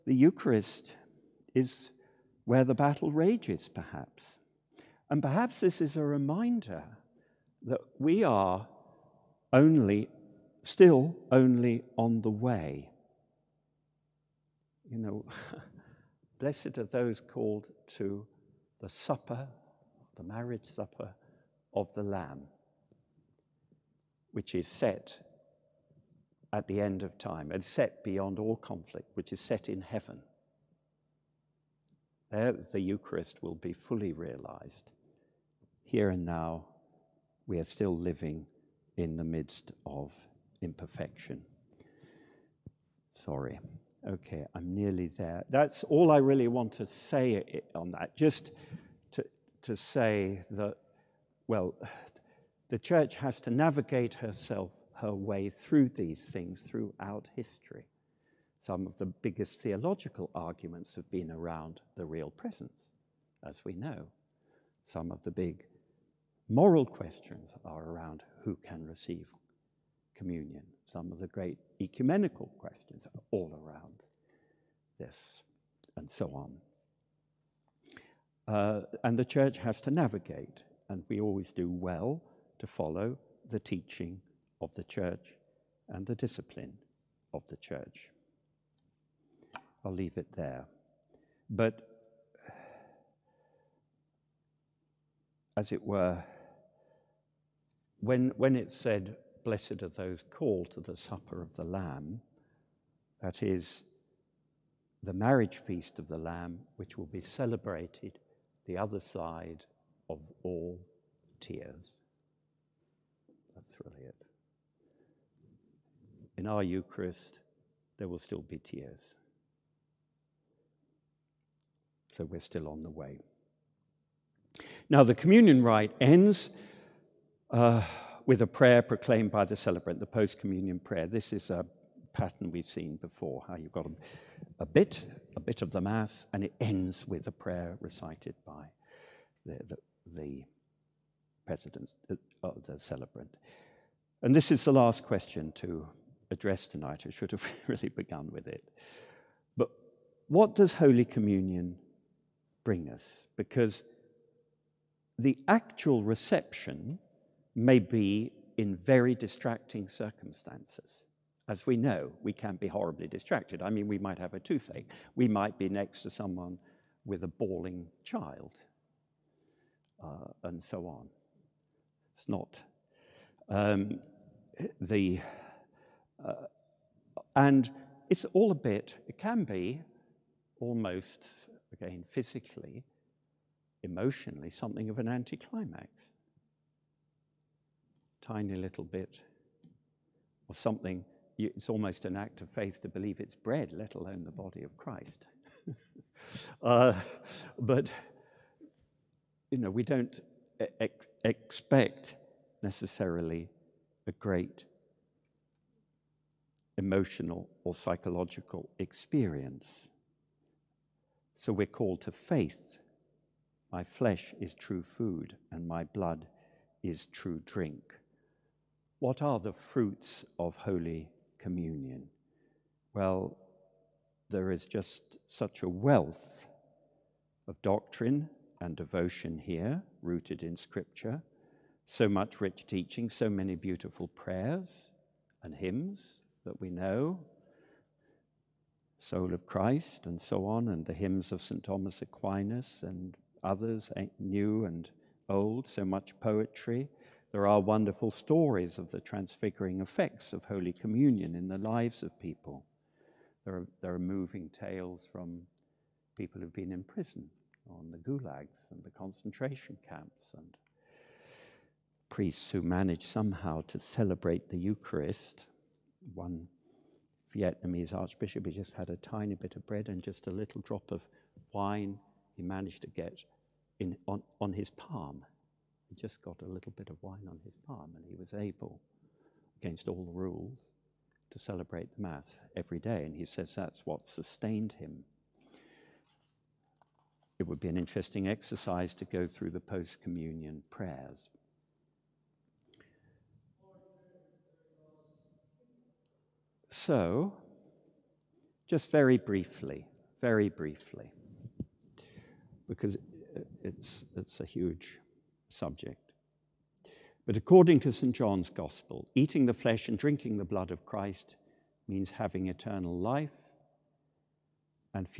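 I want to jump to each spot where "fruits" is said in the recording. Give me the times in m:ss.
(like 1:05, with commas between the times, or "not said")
3:39.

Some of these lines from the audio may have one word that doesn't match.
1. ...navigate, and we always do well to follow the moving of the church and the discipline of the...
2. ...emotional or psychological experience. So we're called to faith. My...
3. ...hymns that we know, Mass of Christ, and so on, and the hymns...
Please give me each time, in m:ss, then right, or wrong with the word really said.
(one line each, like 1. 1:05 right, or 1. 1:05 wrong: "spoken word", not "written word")
1. 1:19 wrong: "teaching", not "moving"
2. 3:26 right
3. 3:55 wrong: "Soul", not "Mass".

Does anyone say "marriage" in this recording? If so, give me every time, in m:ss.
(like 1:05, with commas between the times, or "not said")
0:20, 1:45.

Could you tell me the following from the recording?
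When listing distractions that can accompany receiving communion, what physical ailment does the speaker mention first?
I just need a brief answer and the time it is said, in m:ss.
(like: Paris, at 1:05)
toothache, at 2:44.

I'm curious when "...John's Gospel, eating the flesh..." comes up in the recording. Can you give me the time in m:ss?
5:08.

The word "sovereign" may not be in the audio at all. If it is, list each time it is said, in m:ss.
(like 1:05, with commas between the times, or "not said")
not said.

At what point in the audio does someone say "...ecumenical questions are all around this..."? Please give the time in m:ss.
1:11.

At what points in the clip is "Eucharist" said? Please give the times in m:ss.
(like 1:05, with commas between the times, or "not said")
0:00, 0:32, 1:56, 4:24.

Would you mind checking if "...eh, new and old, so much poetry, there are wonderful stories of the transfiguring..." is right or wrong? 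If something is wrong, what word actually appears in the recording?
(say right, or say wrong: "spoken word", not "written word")
right.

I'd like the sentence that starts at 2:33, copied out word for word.
Because the actual reception may be in very distracting circumstances.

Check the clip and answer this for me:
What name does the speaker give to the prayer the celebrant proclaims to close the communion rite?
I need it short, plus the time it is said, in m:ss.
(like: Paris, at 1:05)
post communion prayer, at 2:10.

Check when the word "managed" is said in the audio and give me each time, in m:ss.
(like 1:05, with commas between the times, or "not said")
4:22, 4:32.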